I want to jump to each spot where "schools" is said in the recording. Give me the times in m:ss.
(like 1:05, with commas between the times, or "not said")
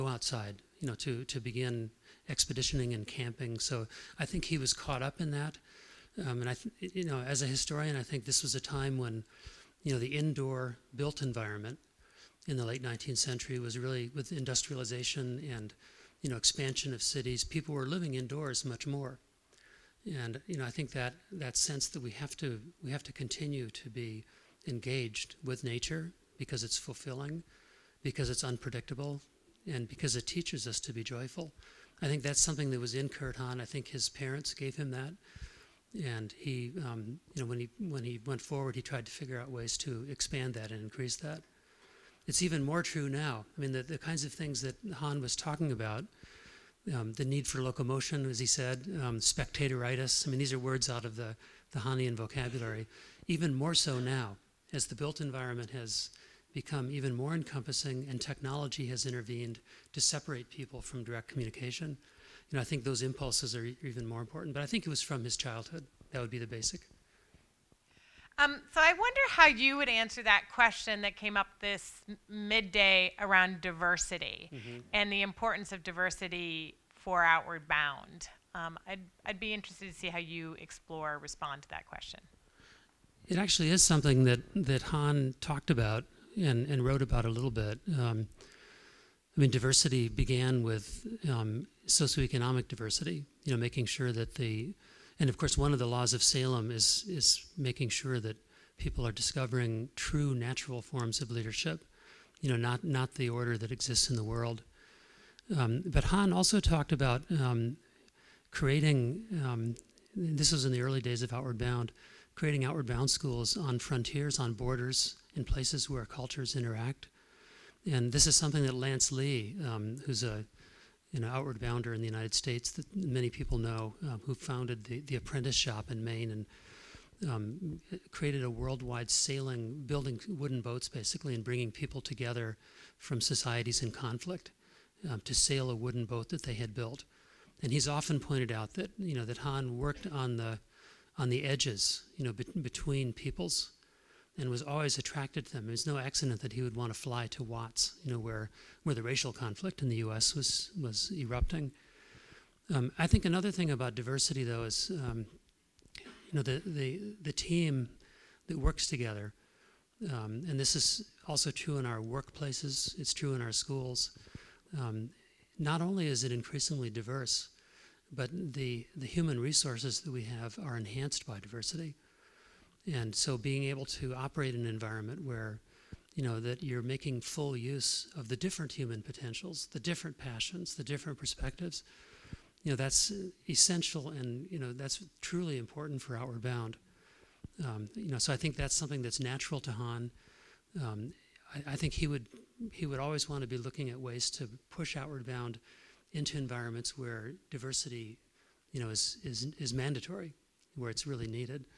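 1:53, 2:43.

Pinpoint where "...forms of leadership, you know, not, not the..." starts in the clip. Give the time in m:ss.
1:40.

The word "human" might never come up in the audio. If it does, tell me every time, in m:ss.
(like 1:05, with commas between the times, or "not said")
2:49, 2:58.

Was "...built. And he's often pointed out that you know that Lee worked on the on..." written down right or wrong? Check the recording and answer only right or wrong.
wrong.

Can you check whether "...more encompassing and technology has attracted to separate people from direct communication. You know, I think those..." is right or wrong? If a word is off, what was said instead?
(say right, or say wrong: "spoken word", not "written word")
wrong: "intervened", not "attracted".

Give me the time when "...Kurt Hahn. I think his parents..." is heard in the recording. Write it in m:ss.
0:33.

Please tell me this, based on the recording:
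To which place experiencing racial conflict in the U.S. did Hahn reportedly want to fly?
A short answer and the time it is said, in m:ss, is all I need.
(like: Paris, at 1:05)
Watts, at 2:27.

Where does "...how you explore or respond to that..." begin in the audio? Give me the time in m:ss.
1:20.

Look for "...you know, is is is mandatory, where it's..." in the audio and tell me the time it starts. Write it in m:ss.
3:18.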